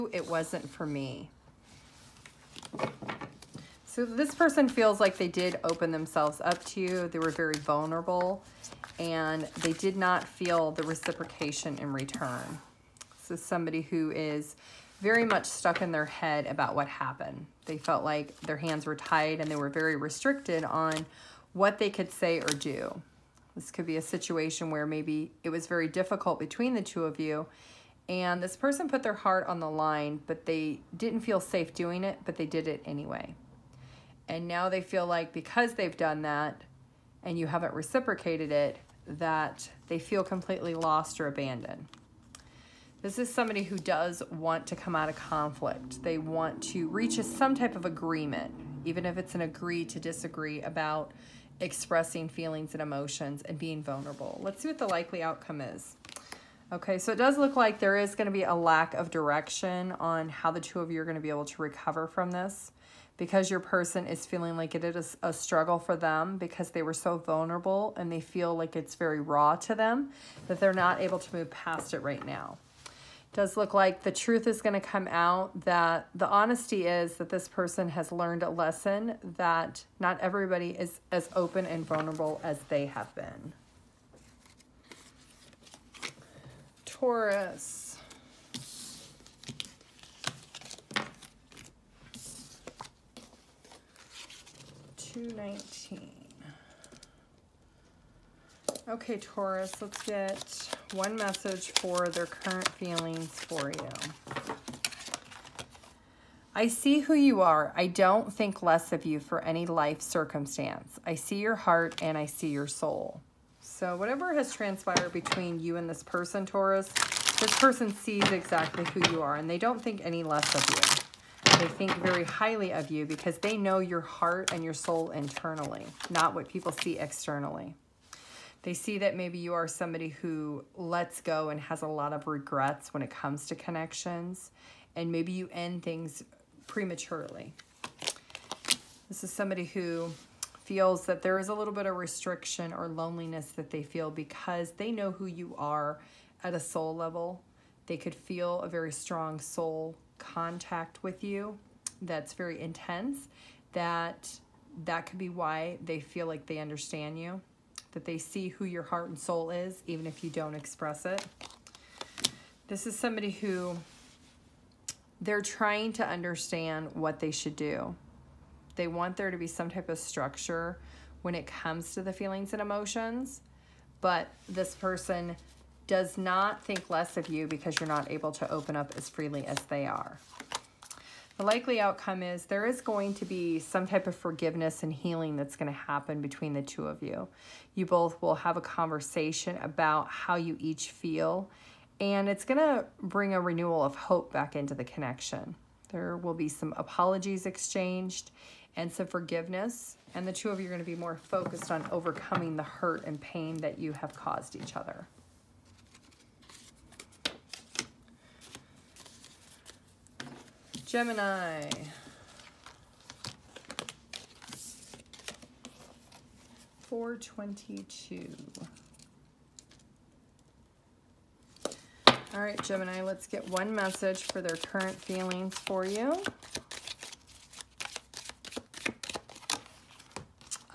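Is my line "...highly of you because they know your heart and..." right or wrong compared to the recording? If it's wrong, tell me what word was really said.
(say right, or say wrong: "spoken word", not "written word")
right.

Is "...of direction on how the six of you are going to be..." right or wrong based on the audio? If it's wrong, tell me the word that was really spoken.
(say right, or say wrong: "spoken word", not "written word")
wrong: "two", not "six".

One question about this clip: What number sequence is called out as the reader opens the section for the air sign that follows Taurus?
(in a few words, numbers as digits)
422.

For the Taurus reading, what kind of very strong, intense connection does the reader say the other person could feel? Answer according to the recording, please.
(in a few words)
soul contact.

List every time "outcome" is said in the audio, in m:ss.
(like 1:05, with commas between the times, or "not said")
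0:55, 3:01.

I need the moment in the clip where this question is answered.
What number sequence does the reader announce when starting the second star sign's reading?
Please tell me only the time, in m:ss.
1:34.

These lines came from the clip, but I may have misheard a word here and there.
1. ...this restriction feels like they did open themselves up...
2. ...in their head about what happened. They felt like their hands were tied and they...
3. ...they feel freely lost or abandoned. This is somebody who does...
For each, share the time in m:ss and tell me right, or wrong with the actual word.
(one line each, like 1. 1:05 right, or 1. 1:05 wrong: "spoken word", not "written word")
1. 0:04 wrong: "person", not "restriction"
2. 0:15 right
3. 0:39 wrong: "completely", not "freely".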